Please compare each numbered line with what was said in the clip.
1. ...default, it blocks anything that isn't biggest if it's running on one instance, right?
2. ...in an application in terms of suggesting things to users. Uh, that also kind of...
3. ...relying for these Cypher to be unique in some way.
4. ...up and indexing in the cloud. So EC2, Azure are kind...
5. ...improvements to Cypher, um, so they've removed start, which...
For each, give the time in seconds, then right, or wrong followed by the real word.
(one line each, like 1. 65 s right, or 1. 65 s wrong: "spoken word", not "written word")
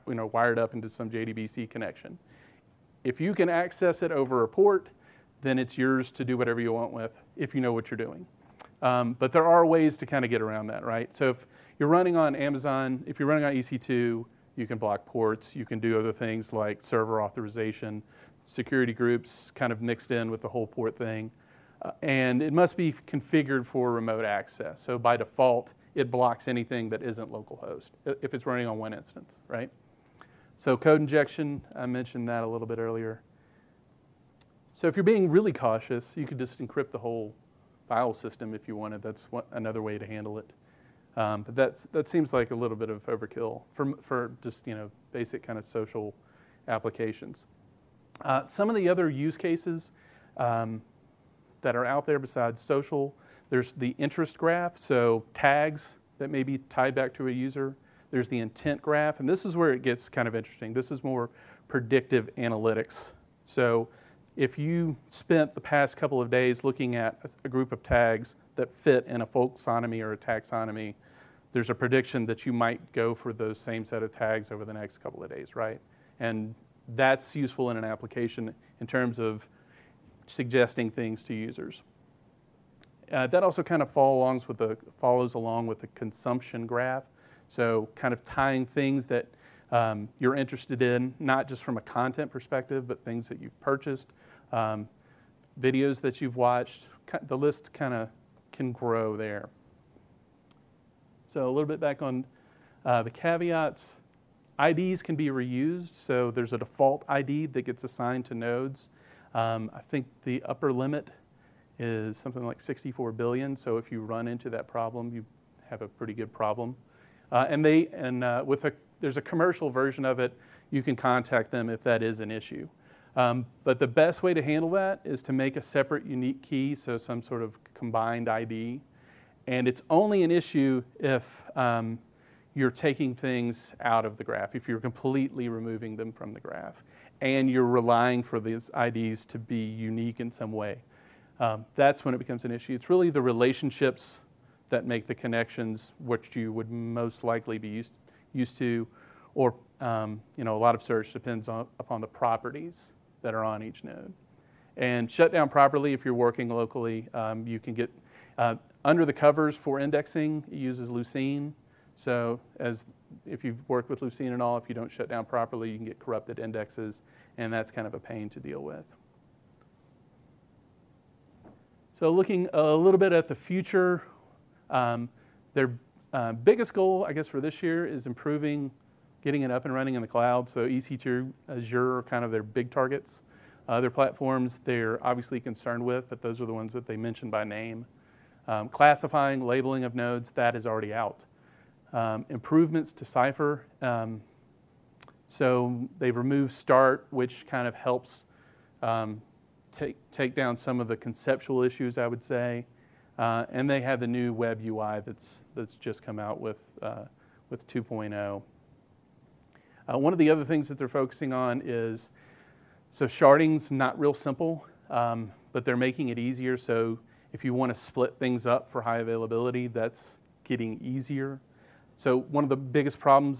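1. 25 s wrong: "localhost", not "biggest"
2. 77 s right
3. 137 s wrong: "IDs", not "Cypher"
4. 179 s wrong: "running", not "indexing"
5. 192 s right.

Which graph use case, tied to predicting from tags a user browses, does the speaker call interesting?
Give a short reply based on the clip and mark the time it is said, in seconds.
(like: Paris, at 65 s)
Intent graph, at 58 s.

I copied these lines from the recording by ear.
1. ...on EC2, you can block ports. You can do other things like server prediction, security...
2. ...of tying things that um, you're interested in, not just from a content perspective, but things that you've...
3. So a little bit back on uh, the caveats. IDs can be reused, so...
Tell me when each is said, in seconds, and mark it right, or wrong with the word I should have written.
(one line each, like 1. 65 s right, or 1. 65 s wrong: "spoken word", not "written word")
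1. 13 s wrong: "authorization", not "prediction"
2. 88 s right
3. 101 s right.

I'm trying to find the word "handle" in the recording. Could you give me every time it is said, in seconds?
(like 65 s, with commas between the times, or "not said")
40 s, 124 s.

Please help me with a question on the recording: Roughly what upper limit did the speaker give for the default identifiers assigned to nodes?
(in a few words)
64 billion.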